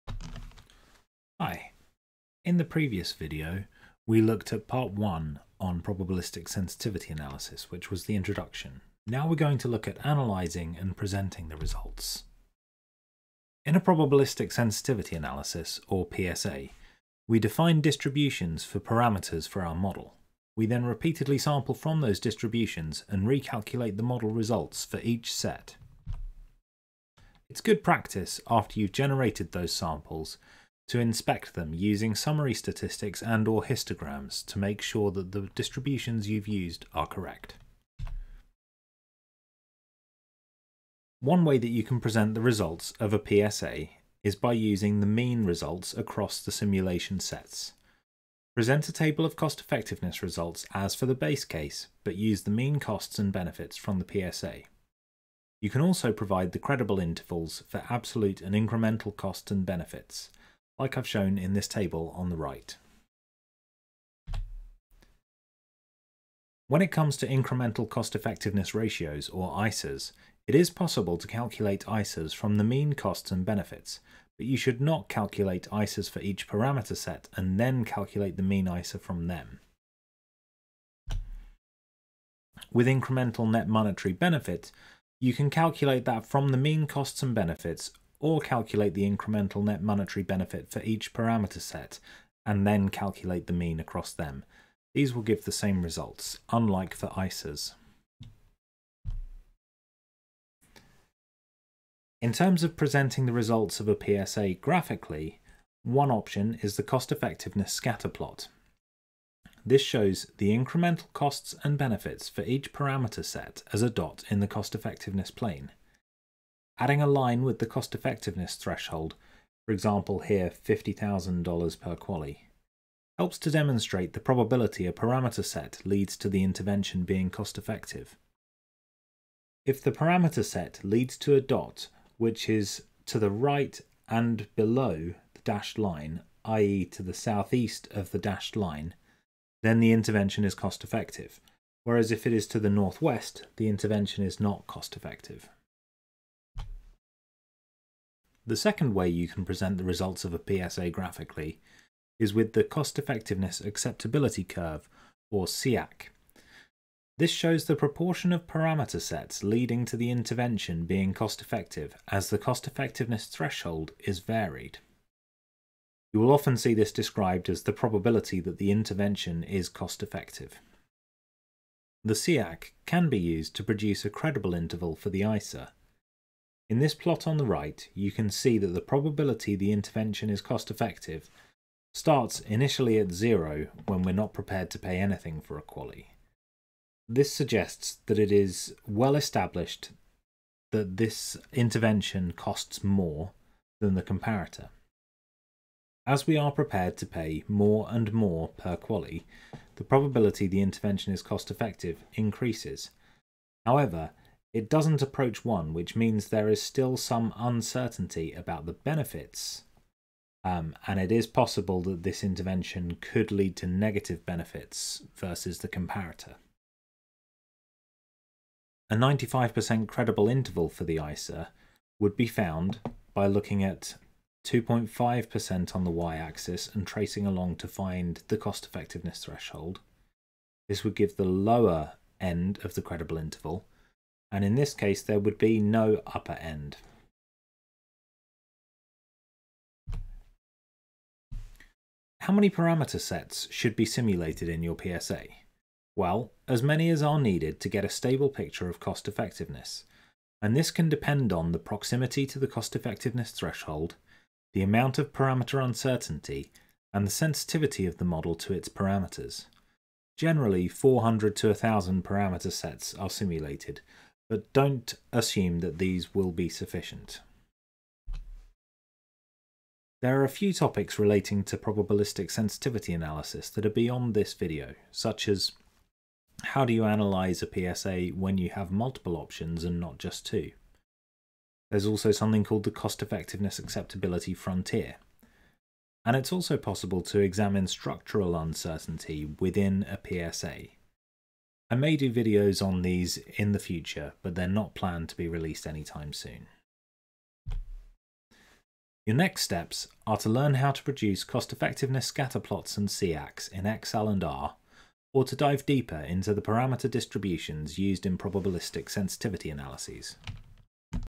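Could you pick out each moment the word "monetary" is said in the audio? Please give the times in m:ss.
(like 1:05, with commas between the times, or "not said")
1:23, 1:29.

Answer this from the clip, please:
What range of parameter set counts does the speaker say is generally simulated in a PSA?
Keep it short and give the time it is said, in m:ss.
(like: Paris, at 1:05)
400 to 1000, at 4:20.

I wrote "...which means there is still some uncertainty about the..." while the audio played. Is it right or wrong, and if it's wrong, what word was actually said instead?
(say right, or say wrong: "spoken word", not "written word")
right.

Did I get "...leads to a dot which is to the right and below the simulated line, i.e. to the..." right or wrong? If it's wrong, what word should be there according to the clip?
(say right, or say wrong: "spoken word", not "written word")
wrong: "dashed", not "simulated".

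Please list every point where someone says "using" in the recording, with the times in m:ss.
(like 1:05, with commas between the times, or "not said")
0:31, 0:44.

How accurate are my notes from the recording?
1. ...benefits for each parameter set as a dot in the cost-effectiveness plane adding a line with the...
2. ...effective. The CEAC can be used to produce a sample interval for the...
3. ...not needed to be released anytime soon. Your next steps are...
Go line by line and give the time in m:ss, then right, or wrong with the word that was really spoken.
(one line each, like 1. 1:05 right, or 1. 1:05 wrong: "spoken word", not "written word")
1. 1:51 right
2. 2:50 wrong: "credible", not "sample"
3. 4:54 wrong: "planned", not "needed".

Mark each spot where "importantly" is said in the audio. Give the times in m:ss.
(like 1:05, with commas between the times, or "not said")
not said.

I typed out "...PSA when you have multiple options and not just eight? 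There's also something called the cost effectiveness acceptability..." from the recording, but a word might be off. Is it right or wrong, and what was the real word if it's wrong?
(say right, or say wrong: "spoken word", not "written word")
wrong: "two", not "eight".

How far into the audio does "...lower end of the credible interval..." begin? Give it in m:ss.
3:51.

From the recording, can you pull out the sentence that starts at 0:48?
Present a table of cost effectiveness results as for the base case, but use the mean costs and benefits from the PSA.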